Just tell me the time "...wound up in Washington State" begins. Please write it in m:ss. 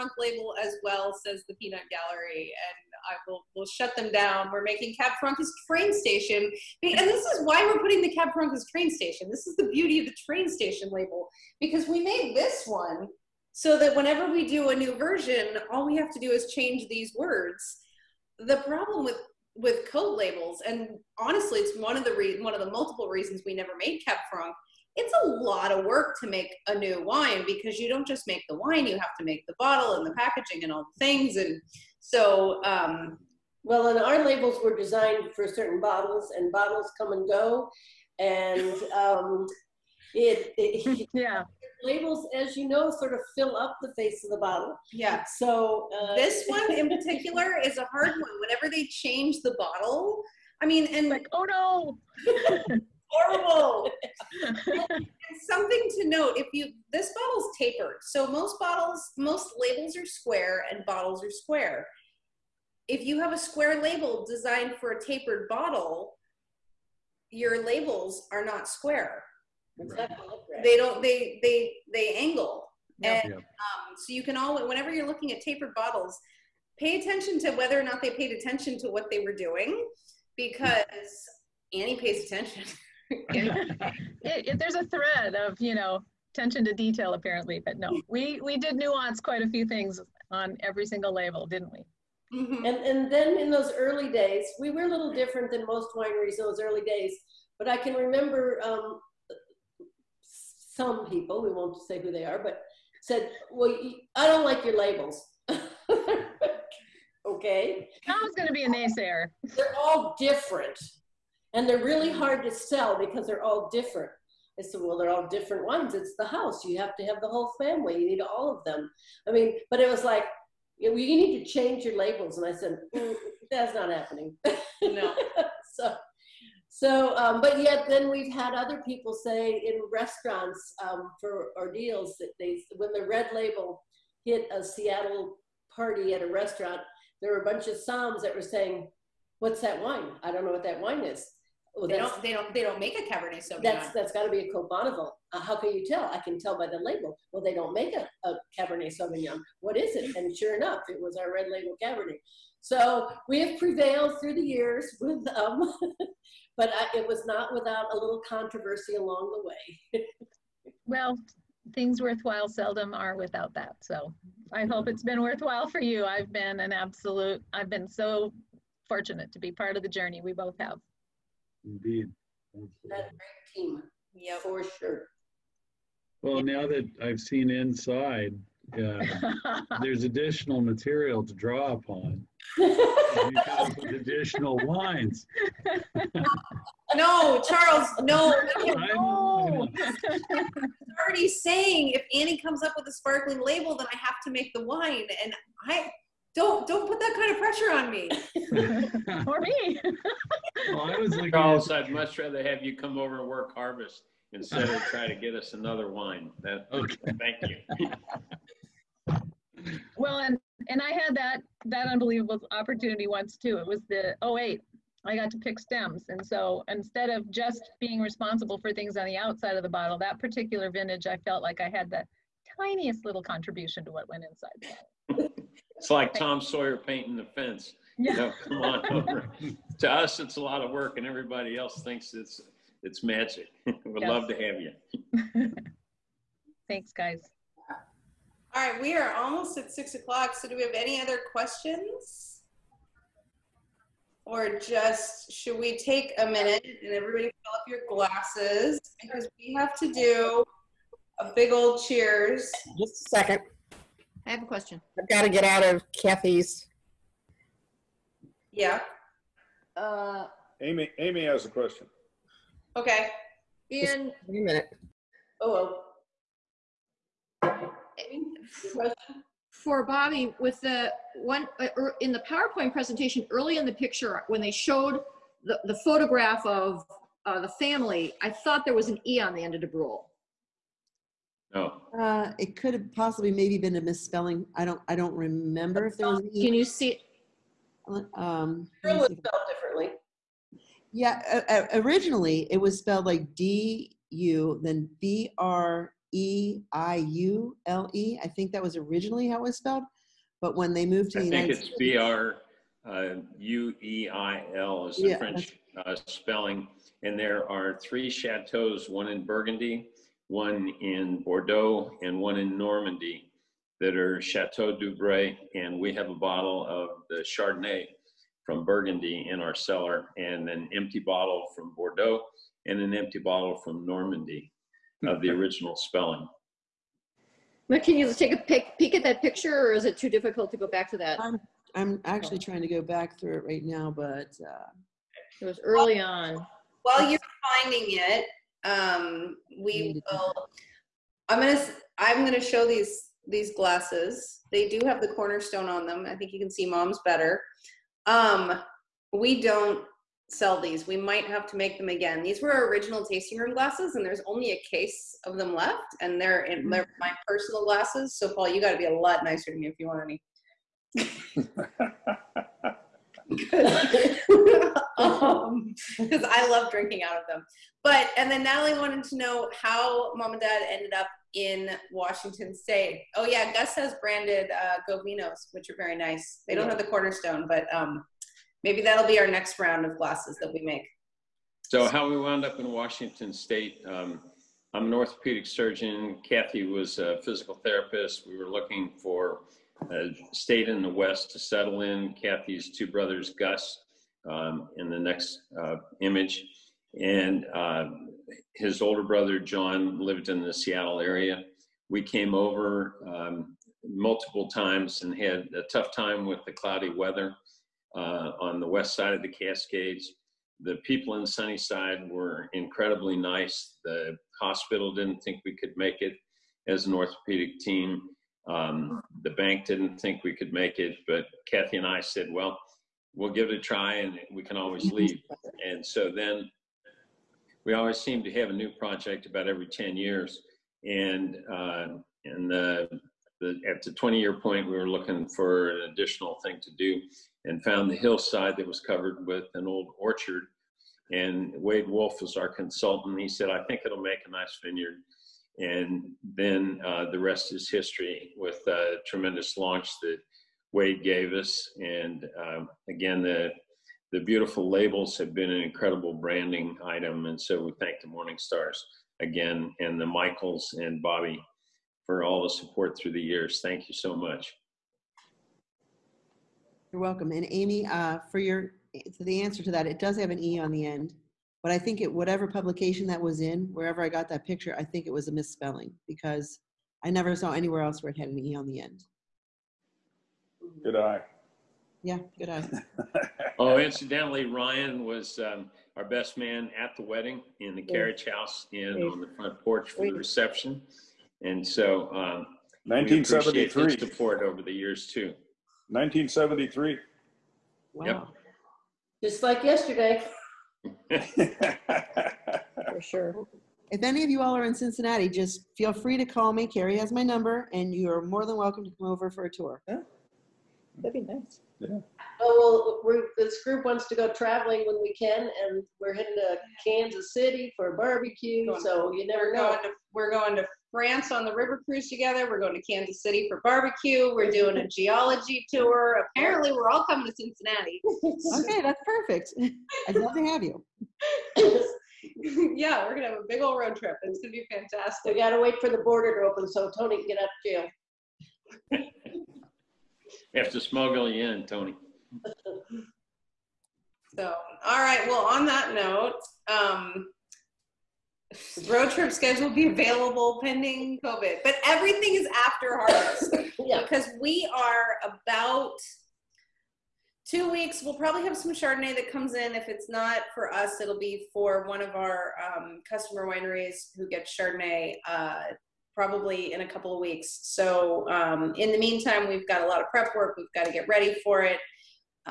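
6:22.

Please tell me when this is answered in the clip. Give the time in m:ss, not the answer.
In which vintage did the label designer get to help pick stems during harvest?
3:34.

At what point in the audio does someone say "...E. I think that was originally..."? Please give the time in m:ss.
4:57.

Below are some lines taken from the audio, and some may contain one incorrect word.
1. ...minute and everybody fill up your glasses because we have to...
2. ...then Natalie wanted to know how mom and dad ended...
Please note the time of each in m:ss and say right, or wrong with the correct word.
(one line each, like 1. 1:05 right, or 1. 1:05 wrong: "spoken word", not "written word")
1. 4:06 right
2. 6:08 right.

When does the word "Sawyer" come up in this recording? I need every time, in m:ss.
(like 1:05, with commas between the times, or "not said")
3:46.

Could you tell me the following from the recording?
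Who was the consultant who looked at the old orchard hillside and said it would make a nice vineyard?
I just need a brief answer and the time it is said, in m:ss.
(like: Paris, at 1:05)
Wade Wolfe, at 7:21.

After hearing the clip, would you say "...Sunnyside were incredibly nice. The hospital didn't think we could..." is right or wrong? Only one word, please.
right.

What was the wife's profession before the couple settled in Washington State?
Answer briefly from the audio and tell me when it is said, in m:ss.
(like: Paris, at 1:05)
physical therapist, at 6:27.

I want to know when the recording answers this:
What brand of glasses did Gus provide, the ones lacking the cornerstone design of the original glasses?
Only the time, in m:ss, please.
6:14.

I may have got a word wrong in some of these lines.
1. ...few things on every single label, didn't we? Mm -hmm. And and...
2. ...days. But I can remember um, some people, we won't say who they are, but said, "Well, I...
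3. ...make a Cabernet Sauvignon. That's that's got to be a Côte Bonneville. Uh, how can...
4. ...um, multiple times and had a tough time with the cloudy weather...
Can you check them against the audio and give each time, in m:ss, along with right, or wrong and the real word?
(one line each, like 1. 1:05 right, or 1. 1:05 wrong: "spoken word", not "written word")
1. 1:29 right
2. 1:36 right
3. 2:22 right
4. 6:43 right.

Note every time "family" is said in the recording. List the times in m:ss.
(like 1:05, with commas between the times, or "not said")
1:57, 4:37.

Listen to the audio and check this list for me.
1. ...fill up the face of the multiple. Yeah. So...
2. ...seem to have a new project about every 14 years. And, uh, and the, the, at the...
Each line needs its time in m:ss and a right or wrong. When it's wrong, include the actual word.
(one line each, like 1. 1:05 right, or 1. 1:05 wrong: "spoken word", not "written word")
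1. 0:43 wrong: "bottle", not "multiple"
2. 7:07 wrong: "10", not "14".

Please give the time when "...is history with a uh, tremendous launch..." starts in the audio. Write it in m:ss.
7:27.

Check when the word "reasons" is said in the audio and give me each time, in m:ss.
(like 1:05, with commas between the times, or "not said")
0:23.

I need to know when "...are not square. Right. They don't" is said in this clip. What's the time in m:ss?
1:08.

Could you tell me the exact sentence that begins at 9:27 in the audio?
So um, in the meantime, we've got a lot of prep work.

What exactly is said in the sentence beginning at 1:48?
I was going to be a naysayer.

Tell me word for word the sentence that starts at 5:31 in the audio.
I'm, I'm actually trying to go back through it right now, but uh, it was early on.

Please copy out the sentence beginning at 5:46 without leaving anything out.
I think you can see mom's better.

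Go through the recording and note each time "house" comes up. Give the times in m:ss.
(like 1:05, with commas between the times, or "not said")
1:56, 8:08.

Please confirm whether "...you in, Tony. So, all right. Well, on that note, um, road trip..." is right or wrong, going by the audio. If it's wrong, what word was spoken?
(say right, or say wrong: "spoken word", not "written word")
right.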